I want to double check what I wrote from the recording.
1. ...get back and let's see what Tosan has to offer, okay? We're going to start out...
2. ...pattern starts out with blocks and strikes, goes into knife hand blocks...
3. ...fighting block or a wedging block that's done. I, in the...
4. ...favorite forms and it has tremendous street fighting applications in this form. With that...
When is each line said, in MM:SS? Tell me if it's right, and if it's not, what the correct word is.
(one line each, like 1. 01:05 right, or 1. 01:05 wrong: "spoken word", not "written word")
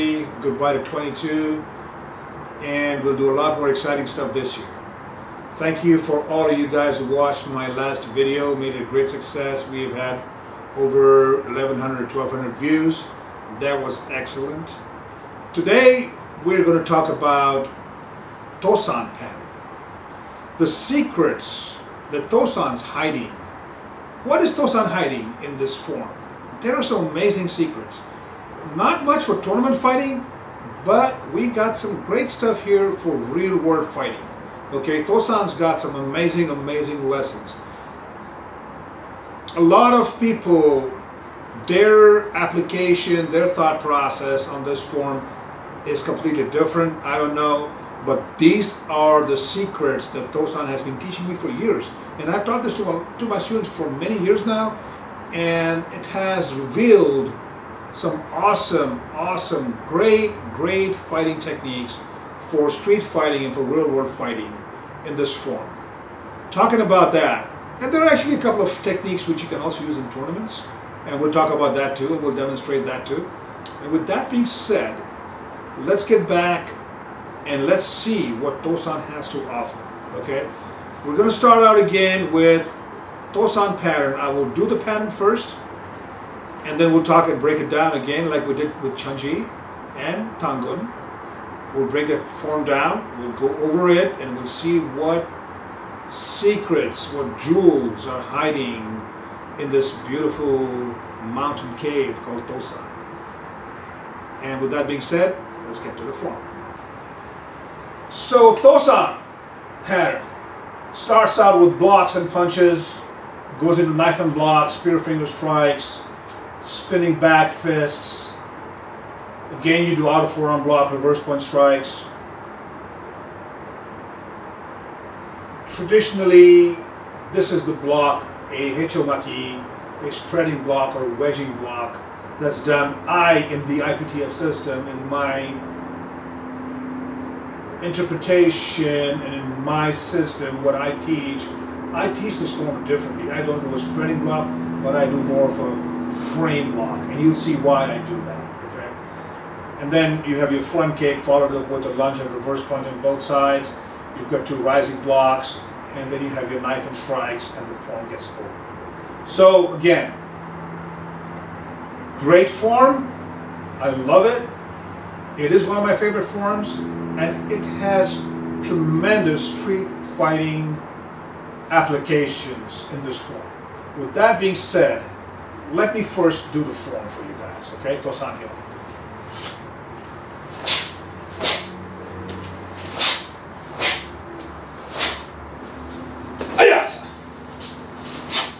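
1. 01:16 right
2. 01:49 wrong: "punches", not "strikes"
3. 02:10 wrong: "spreading", not "fighting"
4. 02:45 right.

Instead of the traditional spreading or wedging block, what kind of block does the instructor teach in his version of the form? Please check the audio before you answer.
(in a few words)
frame block.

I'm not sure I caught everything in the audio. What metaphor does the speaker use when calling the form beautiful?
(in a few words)
mountain cave.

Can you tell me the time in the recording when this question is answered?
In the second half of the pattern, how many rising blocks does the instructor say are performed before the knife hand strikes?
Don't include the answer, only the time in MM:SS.
02:34.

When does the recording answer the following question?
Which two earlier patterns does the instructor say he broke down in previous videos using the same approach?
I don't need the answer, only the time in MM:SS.
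01:28.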